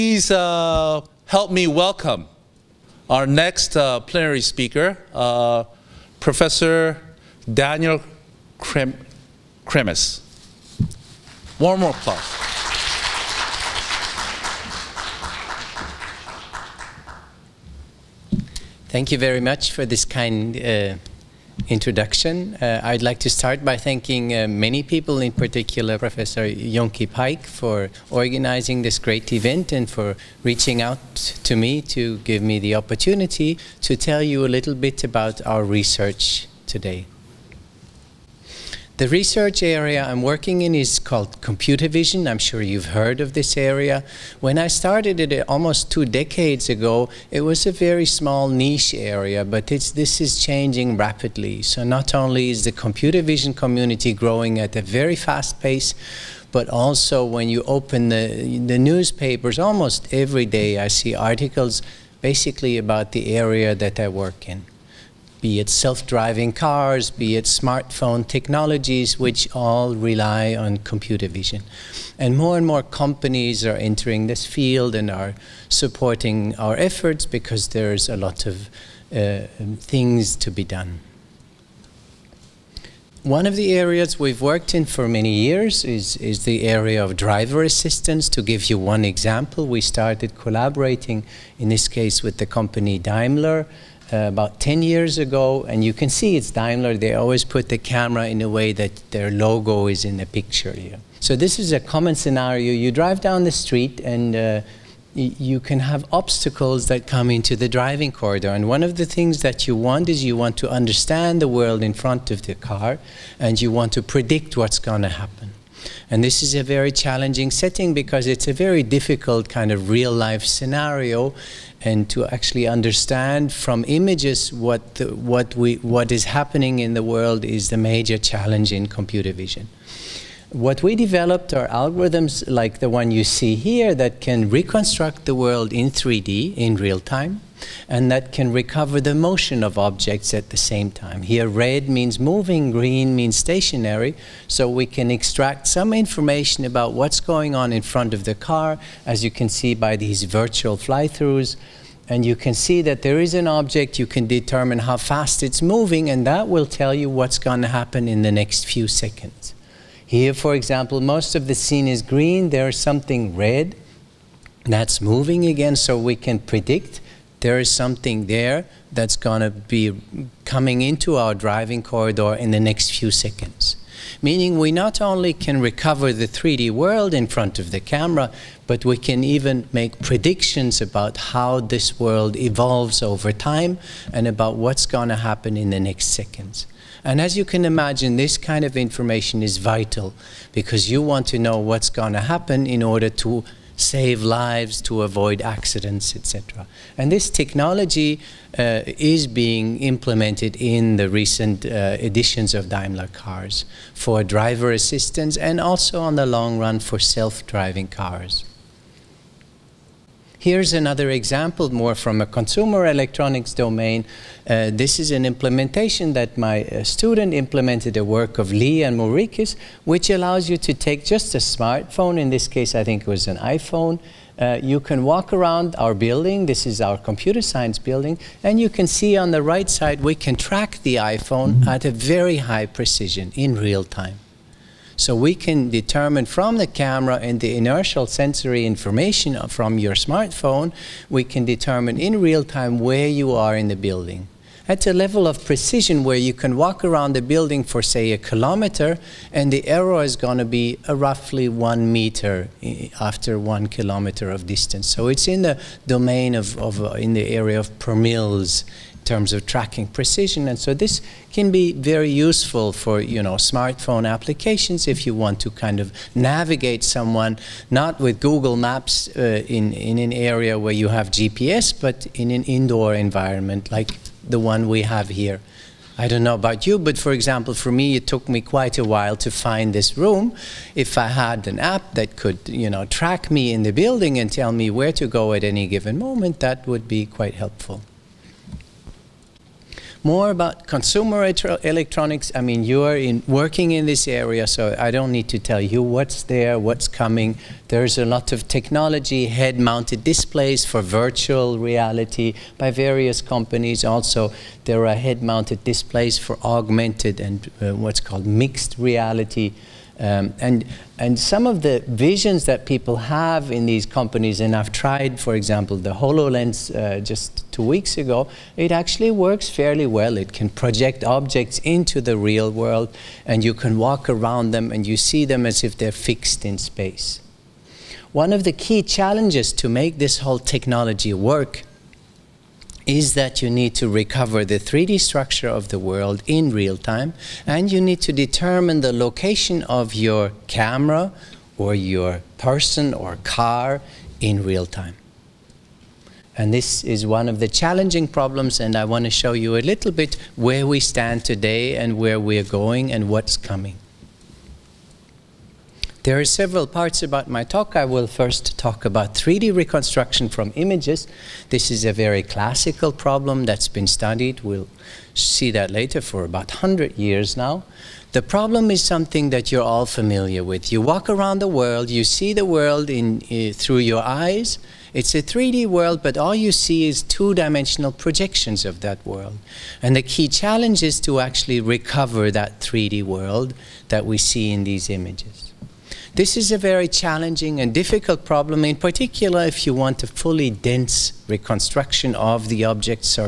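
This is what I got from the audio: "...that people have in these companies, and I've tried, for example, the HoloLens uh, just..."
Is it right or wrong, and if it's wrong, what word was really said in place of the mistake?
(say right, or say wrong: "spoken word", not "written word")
right.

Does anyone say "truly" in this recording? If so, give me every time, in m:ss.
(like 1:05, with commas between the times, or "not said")
not said.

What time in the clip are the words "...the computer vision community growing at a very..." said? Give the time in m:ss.
0:52.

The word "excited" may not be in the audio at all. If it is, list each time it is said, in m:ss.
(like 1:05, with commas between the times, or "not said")
not said.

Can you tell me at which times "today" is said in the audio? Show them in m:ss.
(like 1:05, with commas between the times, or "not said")
0:36, 5:51.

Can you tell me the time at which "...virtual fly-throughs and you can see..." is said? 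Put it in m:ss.
2:30.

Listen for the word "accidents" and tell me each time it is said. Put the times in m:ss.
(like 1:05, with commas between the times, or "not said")
3:15.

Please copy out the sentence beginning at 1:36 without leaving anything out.
They always put the camera in a way that their logo is in the picture here.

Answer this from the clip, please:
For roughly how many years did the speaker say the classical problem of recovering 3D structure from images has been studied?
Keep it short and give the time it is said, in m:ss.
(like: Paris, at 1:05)
100 years, at 6:06.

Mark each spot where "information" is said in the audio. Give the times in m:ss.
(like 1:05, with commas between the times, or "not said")
2:25, 3:08, 3:58.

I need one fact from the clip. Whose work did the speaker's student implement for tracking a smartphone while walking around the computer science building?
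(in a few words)
Lee and Mourikis.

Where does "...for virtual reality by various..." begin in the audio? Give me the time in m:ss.
5:00.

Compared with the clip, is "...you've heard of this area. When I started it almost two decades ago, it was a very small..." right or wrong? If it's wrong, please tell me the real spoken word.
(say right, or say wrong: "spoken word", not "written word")
right.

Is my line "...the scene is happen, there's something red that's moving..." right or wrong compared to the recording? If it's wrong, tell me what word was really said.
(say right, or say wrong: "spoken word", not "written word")
wrong: "green", not "happen".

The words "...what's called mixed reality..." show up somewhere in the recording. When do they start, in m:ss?
5:07.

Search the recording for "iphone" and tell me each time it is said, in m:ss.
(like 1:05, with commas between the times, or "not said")
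3:43, 3:51.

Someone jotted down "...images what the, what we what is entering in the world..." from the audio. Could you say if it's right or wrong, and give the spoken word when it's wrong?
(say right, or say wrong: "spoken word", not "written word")
wrong: "happening", not "entering".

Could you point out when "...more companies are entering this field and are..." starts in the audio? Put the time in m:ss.
1:12.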